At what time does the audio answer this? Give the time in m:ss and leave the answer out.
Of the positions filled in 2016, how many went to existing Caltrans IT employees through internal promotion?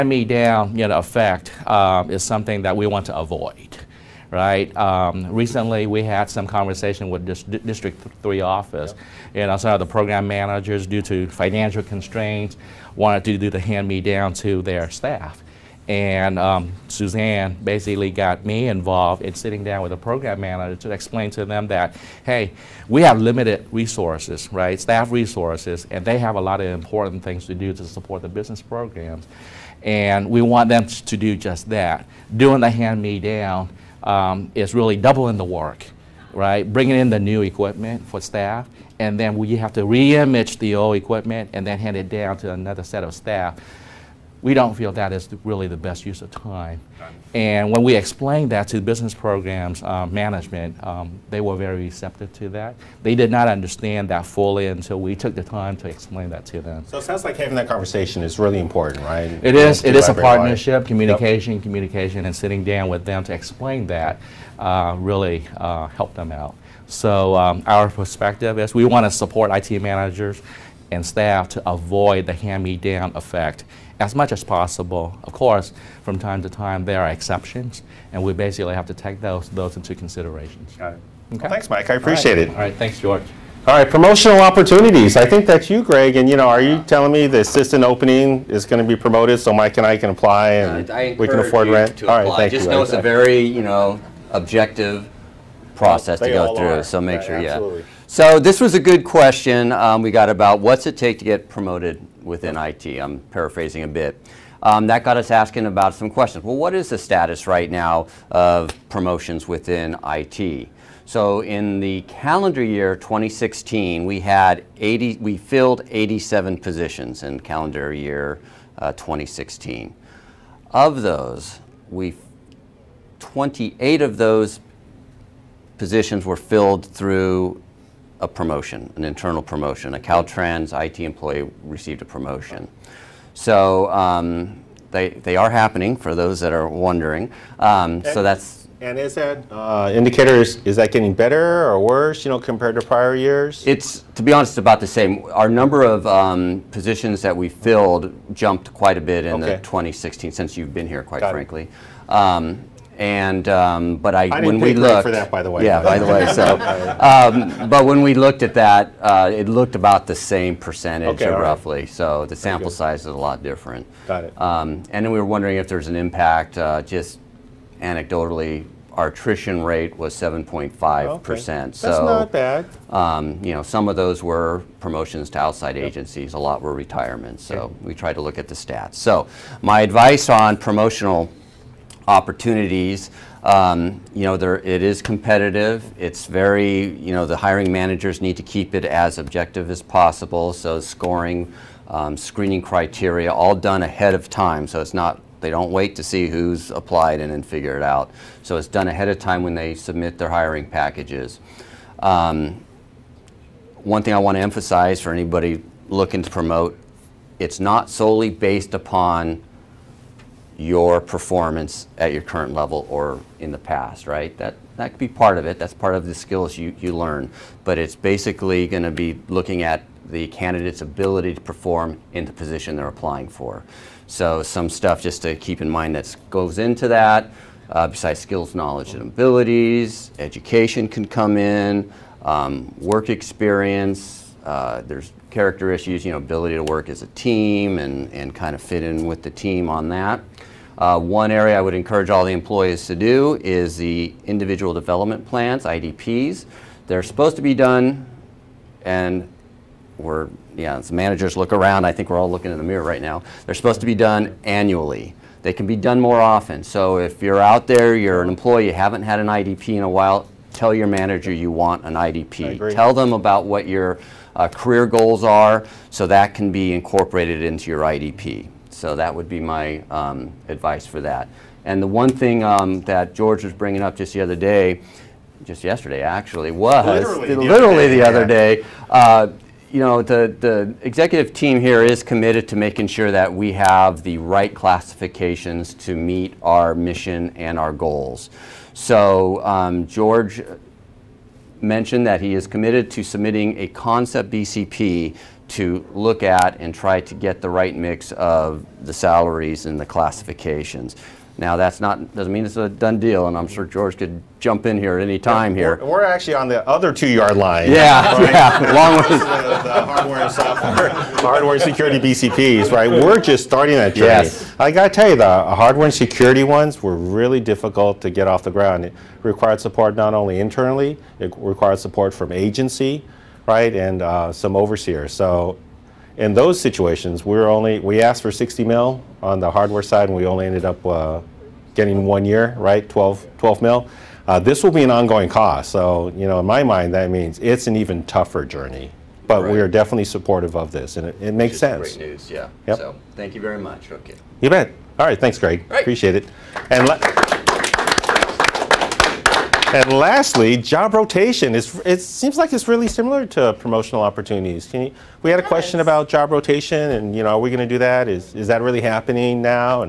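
2:03.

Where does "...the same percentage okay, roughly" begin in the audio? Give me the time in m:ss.
2:40.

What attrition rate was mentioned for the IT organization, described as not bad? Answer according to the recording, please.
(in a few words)
7.5 percent.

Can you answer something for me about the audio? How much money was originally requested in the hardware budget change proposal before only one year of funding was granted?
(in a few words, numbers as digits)
60 million.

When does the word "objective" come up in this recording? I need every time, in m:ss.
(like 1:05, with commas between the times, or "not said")
1:34, 3:09.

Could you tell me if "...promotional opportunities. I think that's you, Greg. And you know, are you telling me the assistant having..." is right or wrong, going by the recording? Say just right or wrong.
wrong.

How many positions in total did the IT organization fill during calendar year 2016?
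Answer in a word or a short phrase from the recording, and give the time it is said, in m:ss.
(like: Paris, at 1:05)
87, at 1:55.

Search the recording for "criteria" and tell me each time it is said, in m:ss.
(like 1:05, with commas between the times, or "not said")
3:12.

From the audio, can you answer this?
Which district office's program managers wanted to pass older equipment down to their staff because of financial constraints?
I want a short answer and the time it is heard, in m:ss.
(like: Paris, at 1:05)
District 3, at 0:07.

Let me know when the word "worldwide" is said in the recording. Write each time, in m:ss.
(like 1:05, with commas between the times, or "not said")
not said.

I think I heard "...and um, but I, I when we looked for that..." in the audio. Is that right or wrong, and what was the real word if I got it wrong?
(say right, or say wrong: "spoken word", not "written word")
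right.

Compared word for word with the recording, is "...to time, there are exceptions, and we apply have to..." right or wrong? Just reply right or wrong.
wrong.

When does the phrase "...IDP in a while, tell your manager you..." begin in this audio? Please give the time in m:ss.
4:19.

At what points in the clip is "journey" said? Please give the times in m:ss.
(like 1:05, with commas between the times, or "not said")
5:13, 5:38.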